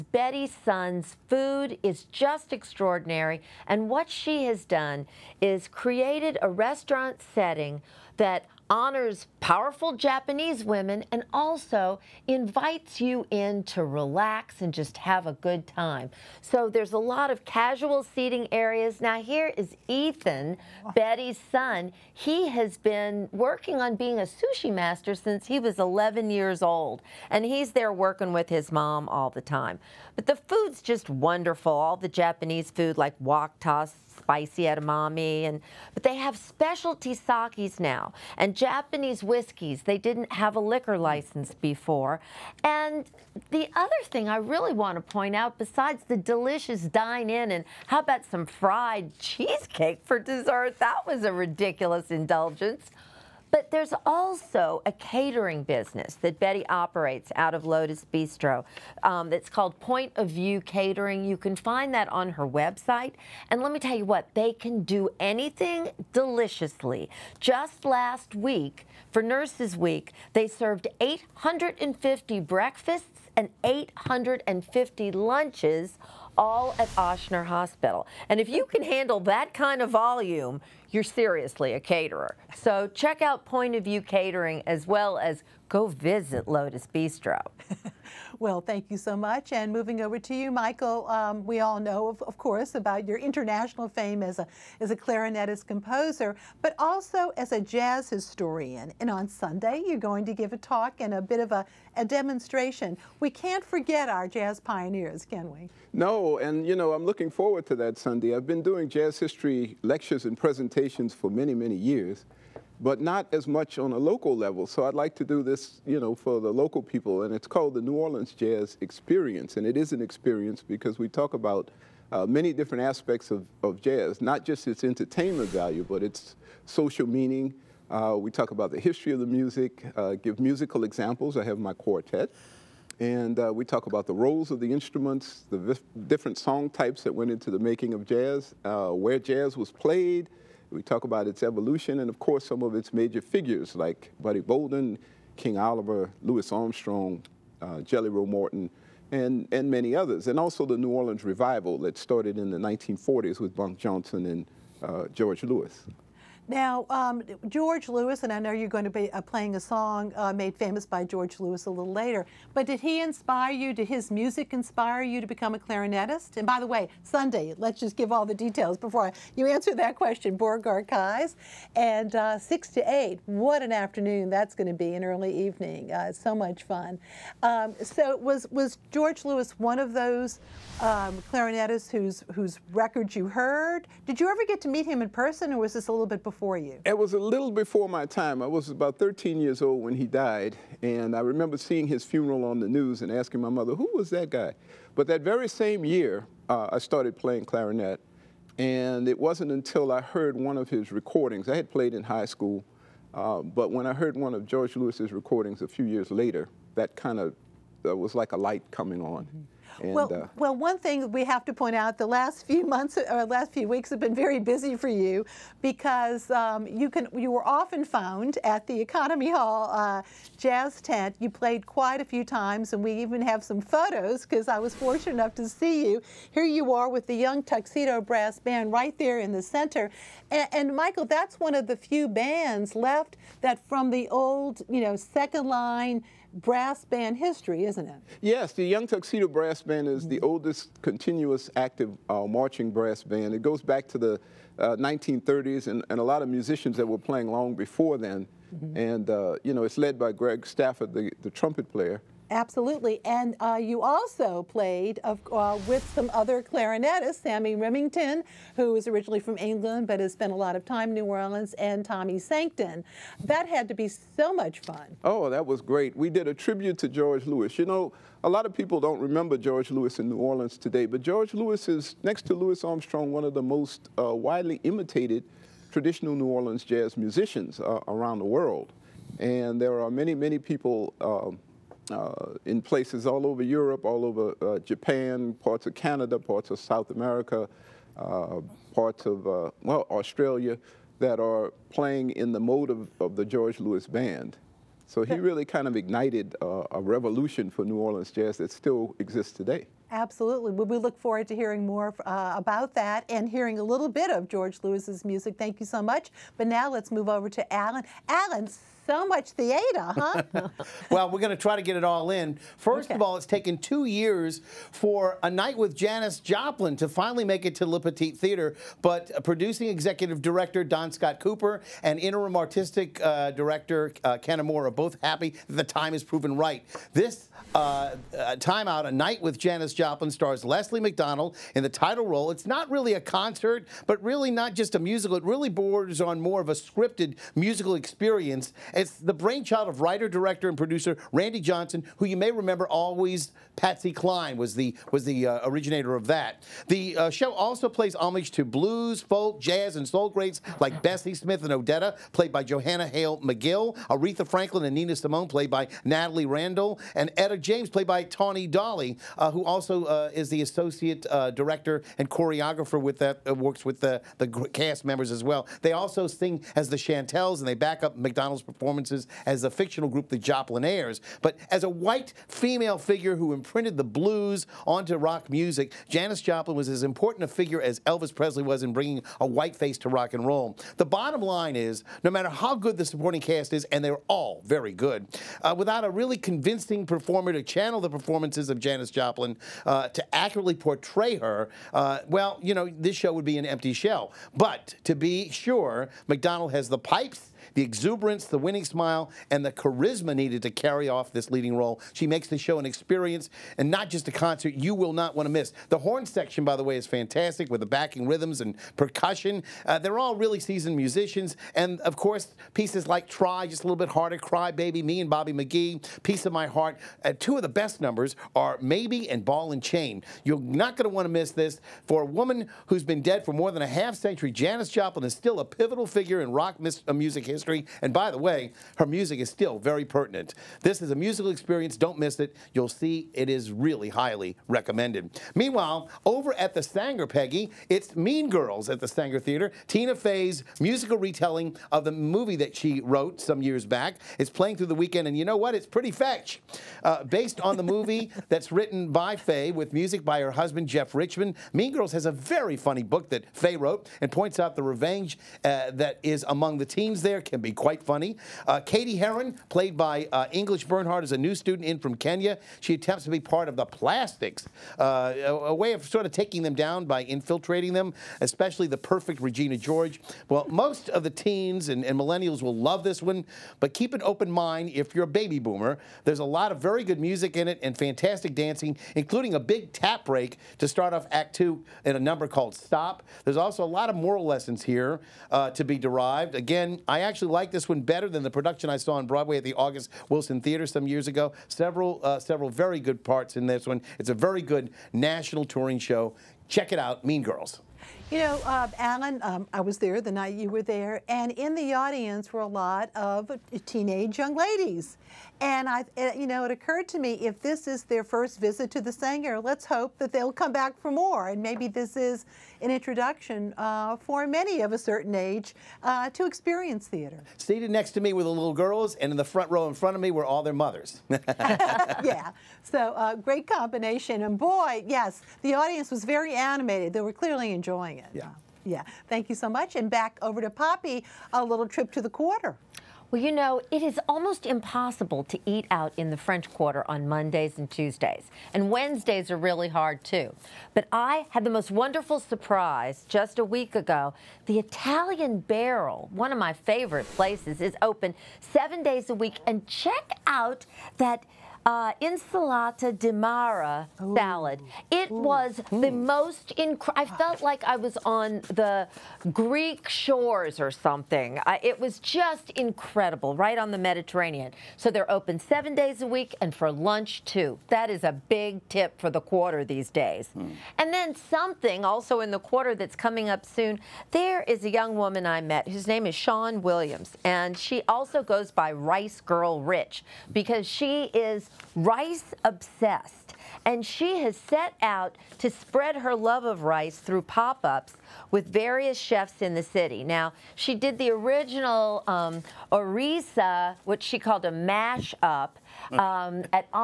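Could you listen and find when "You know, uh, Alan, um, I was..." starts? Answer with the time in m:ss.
8:18.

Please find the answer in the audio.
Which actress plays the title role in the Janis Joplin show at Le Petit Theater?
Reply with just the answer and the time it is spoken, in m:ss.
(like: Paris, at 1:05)
Leslie McDonald, at 5:30.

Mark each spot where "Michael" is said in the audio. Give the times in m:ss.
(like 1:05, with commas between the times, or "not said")
1:30, 3:50.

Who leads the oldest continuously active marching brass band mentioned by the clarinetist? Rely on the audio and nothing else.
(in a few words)
Greg Stafford.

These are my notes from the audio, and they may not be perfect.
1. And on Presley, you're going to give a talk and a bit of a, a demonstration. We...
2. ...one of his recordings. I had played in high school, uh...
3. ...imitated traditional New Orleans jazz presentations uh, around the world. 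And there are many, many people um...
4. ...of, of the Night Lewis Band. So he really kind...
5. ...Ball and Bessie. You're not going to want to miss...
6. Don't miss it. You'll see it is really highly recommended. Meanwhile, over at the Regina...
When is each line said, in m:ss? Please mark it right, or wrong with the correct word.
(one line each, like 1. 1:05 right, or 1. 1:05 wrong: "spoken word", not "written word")
1. 1:39 wrong: "Sunday", not "Presley"
2. 3:20 right
3. 4:34 wrong: "musicians", not "presentations"
4. 4:52 wrong: "George", not "Night"
5. 6:59 wrong: "Chain", not "Bessie"
6. 7:11 wrong: "Sanger", not "Regina".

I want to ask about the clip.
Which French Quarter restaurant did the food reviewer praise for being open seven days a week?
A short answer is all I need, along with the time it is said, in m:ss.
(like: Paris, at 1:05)
The Italian Barrel, at 9:04.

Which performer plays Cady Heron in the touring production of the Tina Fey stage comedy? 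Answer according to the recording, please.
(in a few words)
English Bernhardt.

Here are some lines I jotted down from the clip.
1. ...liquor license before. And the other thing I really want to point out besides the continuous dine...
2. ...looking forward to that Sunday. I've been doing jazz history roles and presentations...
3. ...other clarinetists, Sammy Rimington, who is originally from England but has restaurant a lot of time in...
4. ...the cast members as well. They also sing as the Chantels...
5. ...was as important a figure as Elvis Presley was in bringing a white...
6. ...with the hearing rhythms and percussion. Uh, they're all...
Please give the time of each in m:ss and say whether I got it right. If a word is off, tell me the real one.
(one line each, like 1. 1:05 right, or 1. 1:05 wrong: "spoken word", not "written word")
1. 0:40 wrong: "delicious", not "continuous"
2. 1:47 wrong: "lectures", not "roles"
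3. 4:16 wrong: "spent", not "restaurant"
4. 6:04 right
5. 6:16 right
6. 6:47 wrong: "backing", not "hearing".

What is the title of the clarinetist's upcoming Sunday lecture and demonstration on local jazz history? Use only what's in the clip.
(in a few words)
New Orleans Jazz Experience.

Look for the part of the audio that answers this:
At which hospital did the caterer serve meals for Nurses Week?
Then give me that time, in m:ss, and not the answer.
1:16.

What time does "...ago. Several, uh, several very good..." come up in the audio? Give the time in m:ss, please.
8:11.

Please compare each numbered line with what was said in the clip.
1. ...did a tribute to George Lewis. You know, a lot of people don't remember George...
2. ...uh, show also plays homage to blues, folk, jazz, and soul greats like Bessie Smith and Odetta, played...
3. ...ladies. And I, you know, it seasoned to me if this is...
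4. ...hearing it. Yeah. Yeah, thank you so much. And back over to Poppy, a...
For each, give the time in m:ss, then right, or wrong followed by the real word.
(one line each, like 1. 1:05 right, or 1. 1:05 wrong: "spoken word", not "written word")
1. 4:26 right
2. 5:46 right
3. 8:24 wrong: "occurred", not "seasoned"
4. 8:47 wrong: "enjoying", not "hearing".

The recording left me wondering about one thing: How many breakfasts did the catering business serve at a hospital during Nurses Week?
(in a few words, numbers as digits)
850.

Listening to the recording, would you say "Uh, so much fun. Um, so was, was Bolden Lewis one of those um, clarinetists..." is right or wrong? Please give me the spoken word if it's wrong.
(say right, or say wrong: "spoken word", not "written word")
wrong: "George", not "Bolden".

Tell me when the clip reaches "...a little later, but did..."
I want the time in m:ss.
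2:41.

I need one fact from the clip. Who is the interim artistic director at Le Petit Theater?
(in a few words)
Ken Amore.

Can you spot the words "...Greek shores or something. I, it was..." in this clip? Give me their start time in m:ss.
9:19.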